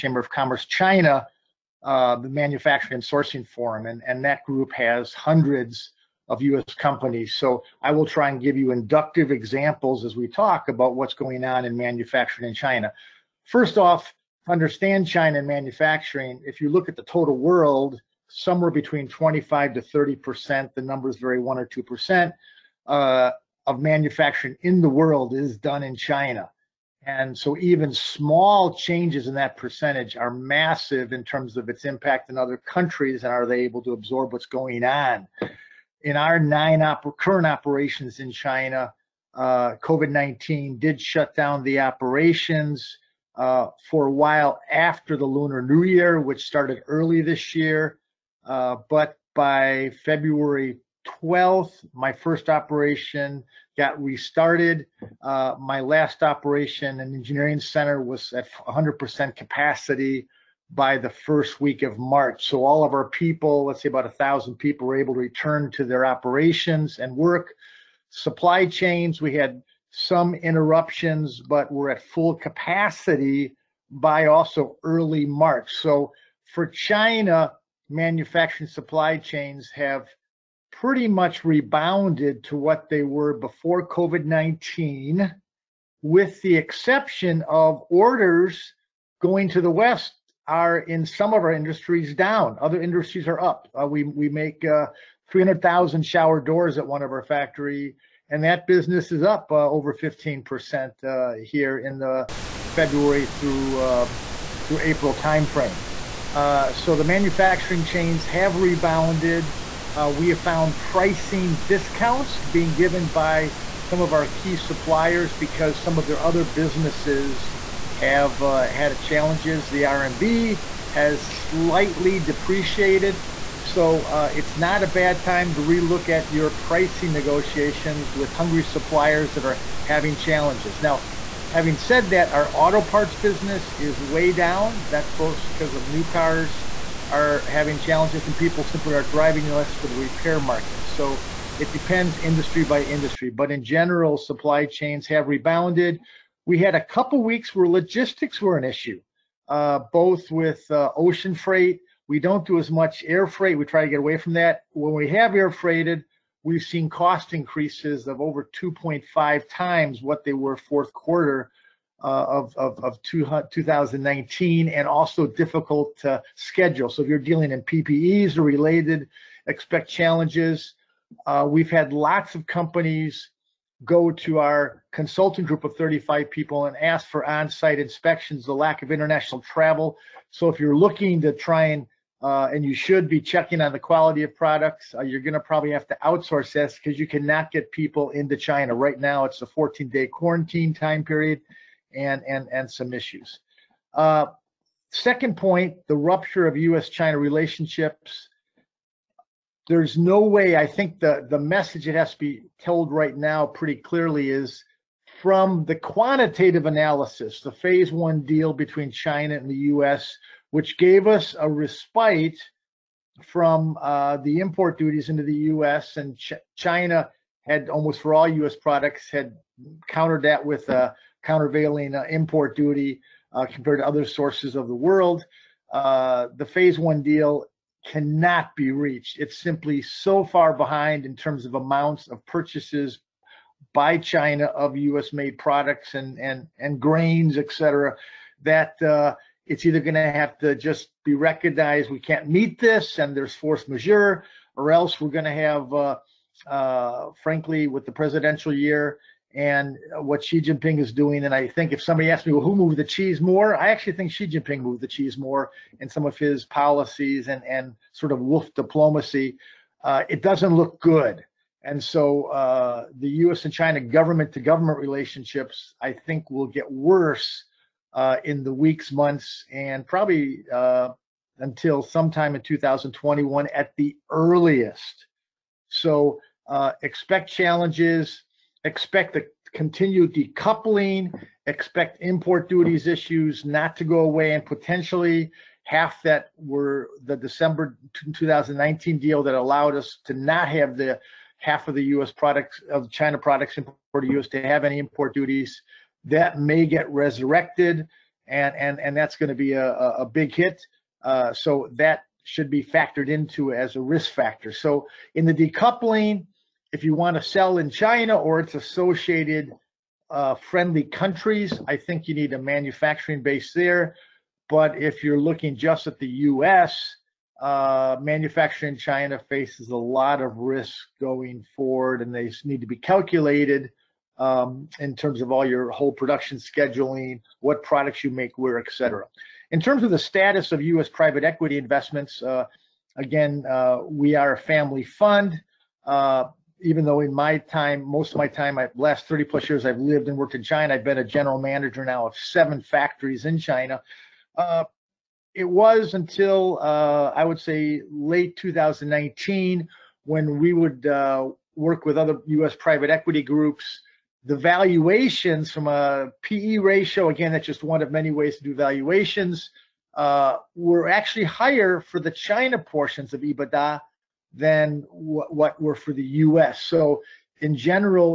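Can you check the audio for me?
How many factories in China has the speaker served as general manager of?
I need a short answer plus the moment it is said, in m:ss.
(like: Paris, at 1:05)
7, at 5:42.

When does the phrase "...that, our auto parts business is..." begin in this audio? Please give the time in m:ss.
2:12.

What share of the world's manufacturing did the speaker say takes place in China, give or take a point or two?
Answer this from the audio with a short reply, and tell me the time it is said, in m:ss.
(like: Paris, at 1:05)
25 to 30 percent, at 0:19.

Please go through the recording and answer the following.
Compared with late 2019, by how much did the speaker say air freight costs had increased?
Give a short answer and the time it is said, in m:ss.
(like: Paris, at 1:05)
2.5 times, at 2:38.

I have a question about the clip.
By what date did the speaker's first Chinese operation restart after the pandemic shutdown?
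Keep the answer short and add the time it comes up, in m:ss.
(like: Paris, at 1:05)
February 12th, at 0:50.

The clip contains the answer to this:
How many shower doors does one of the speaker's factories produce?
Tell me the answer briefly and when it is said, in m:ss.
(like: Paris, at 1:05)
300,000, at 1:35.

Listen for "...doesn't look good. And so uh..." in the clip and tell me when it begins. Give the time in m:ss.
4:20.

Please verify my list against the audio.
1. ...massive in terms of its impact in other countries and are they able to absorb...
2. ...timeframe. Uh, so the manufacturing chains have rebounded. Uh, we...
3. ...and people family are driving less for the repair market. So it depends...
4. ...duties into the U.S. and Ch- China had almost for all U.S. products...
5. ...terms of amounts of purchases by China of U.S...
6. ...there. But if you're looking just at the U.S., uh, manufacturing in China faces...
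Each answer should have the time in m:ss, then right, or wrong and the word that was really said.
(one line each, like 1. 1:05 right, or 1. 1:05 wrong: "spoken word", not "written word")
1. 0:30 right
2. 1:45 right
3. 2:18 wrong: "simply", not "family"
4. 3:34 right
5. 3:51 right
6. 5:13 right.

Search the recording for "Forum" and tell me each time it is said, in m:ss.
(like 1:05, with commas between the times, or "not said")
0:03.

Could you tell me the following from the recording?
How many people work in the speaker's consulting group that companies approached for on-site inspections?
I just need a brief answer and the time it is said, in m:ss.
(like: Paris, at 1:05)
35, at 2:55.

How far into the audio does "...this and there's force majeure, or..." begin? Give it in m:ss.
4:02.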